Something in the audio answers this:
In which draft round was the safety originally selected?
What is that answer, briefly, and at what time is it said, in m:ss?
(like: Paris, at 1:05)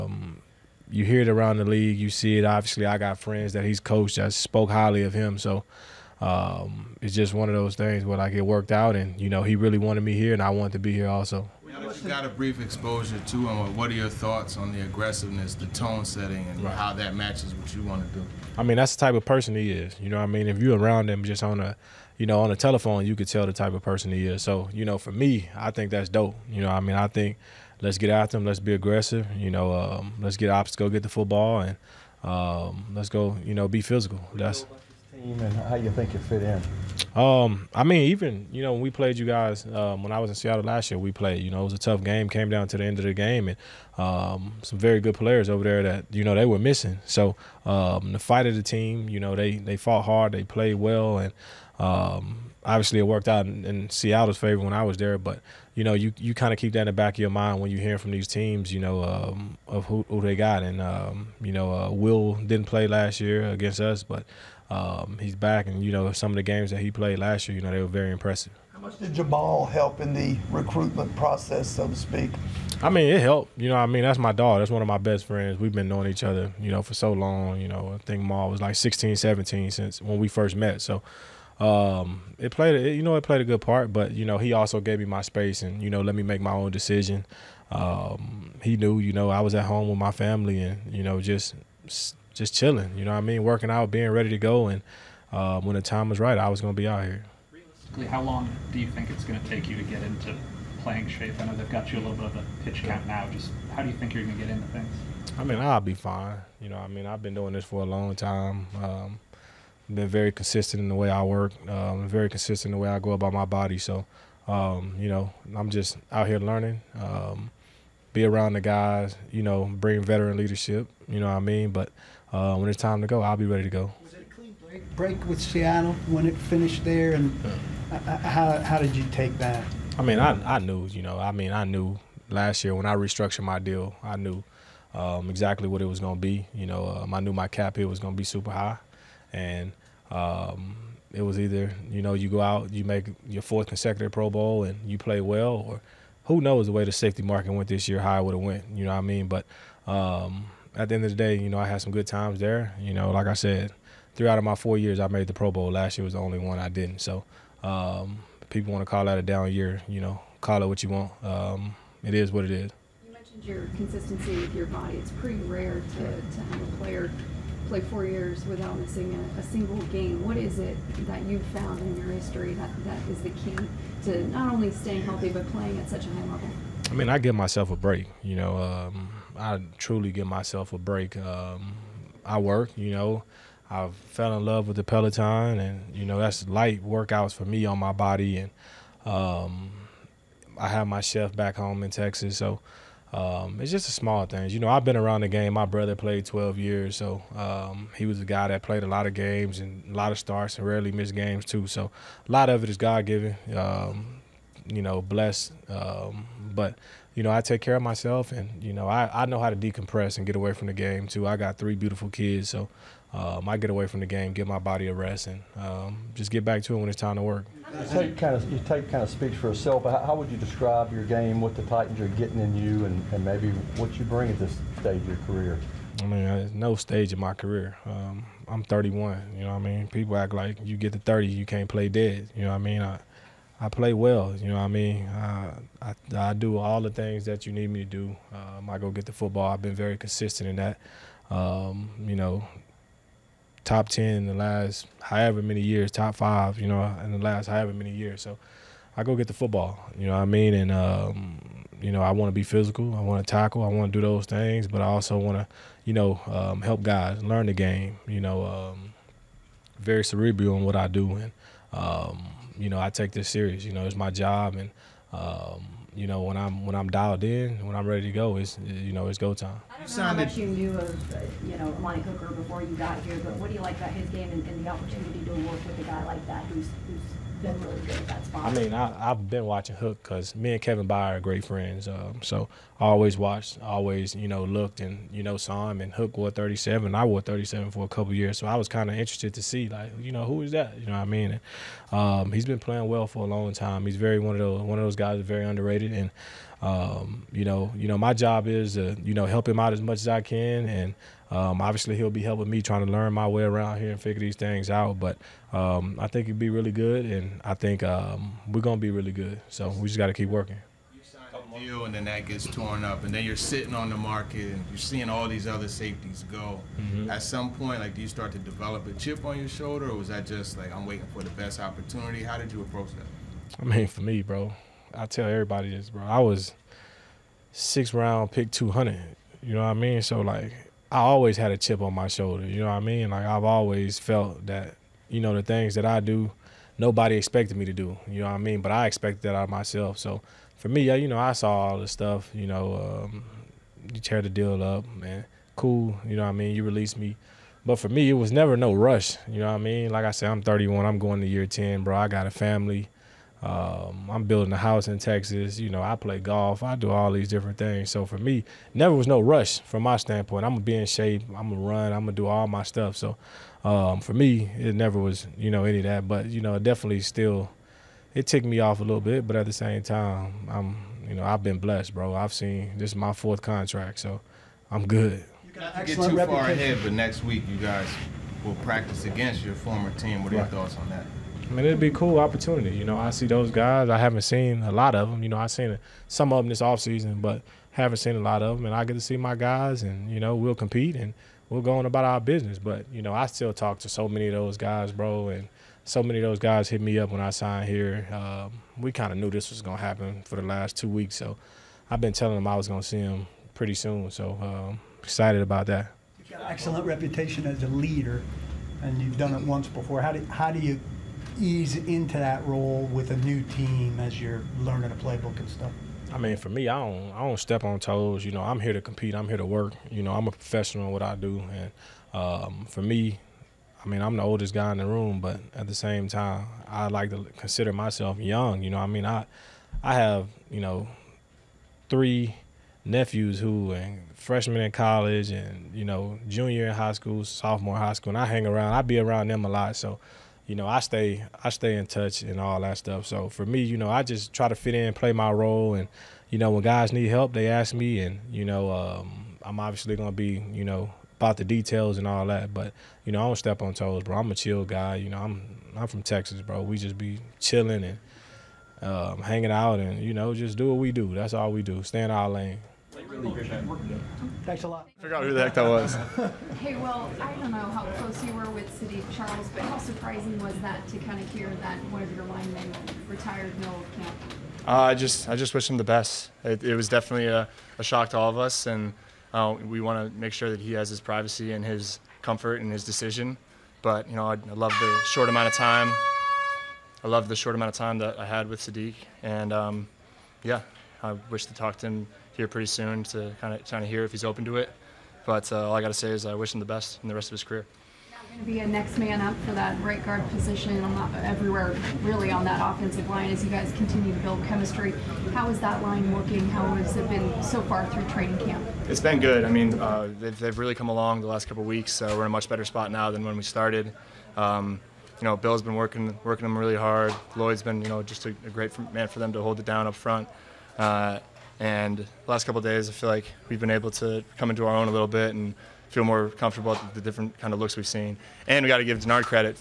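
6th round, at 5:27.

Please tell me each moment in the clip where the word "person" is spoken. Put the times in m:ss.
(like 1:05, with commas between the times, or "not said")
0:19, 0:23.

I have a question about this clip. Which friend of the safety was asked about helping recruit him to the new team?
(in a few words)
Jamal.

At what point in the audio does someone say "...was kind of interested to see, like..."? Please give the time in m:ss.
4:48.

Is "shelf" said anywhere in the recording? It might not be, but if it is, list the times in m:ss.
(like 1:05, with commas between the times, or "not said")
not said.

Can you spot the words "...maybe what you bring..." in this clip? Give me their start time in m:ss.
3:43.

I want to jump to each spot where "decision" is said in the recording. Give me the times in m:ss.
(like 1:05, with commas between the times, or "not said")
1:26, 8:02.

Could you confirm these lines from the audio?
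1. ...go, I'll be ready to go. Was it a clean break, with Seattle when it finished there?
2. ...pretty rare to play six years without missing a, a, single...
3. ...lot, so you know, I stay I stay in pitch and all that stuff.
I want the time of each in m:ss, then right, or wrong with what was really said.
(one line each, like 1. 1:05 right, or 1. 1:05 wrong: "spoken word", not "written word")
1. 2:03 right
2. 2:45 wrong: "four", not "six"
3. 7:19 wrong: "touch", not "pitch".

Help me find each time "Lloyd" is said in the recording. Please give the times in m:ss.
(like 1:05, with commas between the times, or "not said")
8:37.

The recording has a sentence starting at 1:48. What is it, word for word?
Um, been very consistent in the way I work, um, very consistent in the way I go about my body.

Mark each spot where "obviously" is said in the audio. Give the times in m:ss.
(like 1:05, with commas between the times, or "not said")
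0:02, 0:52, 5:01, 7:29.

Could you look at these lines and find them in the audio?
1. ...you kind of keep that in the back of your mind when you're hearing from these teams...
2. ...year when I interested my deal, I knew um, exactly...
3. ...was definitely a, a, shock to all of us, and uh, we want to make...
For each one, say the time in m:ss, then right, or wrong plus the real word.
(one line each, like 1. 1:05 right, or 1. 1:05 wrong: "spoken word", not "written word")
1. 0:56 right
2. 2:12 wrong: "restructured", not "interested"
3. 7:56 right.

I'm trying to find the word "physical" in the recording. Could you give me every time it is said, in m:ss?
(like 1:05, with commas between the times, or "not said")
0:33, 4:12.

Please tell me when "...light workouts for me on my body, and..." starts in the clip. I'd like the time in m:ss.
3:06.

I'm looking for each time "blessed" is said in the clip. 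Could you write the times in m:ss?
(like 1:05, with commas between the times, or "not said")
3:24, 6:11.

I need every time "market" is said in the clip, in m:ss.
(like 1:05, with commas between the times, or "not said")
2:27, 5:13.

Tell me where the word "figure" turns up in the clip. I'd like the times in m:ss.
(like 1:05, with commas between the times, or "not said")
5:03, 7:44.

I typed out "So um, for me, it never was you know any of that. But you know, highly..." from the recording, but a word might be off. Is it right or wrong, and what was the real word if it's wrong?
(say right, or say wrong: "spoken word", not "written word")
wrong: "definitely", not "highly".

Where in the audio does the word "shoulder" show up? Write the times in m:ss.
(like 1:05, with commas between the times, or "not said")
5:19, 5:32.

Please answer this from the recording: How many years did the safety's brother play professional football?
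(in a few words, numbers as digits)
12.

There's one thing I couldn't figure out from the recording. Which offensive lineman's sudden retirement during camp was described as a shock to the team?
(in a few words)
Saahdiq Charles.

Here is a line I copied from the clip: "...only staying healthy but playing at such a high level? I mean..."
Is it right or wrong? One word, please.
right.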